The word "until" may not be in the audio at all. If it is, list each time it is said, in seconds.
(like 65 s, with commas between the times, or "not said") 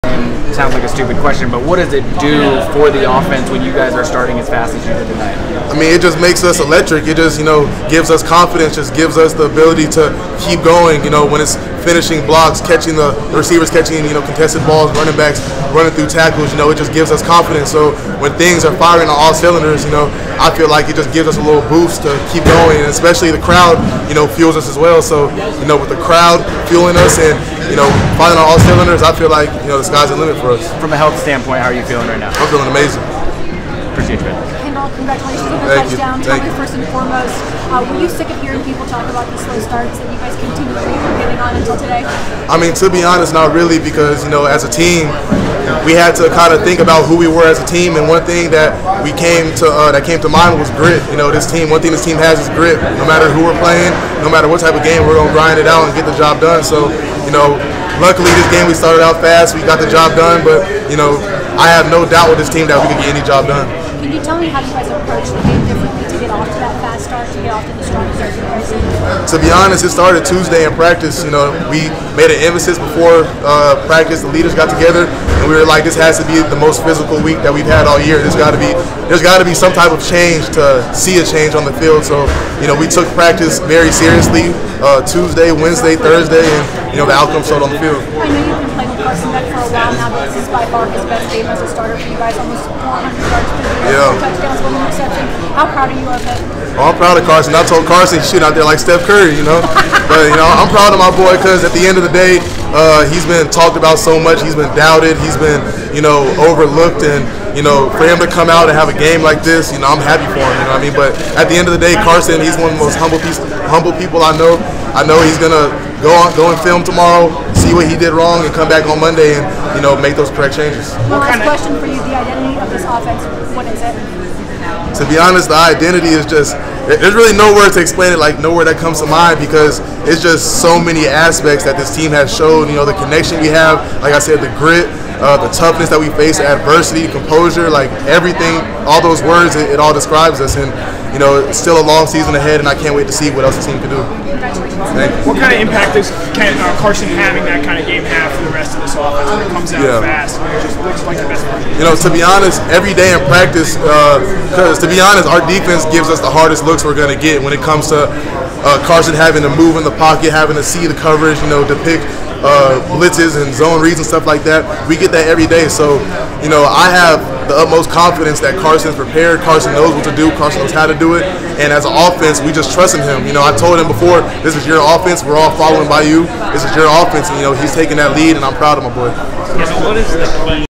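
41 s.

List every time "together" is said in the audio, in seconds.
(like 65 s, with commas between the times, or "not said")
74 s.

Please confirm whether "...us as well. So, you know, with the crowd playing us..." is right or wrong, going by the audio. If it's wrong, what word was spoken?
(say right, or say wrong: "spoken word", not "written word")
wrong: "fueling", not "playing".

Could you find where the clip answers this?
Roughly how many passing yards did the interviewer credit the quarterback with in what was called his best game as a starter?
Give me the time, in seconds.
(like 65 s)
92 s.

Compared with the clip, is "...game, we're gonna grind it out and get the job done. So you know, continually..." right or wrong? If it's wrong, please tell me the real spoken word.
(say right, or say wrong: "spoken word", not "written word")
wrong: "luckily", not "continually".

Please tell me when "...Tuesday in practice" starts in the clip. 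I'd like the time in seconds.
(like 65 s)
70 s.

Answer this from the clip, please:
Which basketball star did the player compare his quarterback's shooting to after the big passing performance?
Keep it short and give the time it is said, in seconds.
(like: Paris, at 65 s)
Steph Curry, at 98 s.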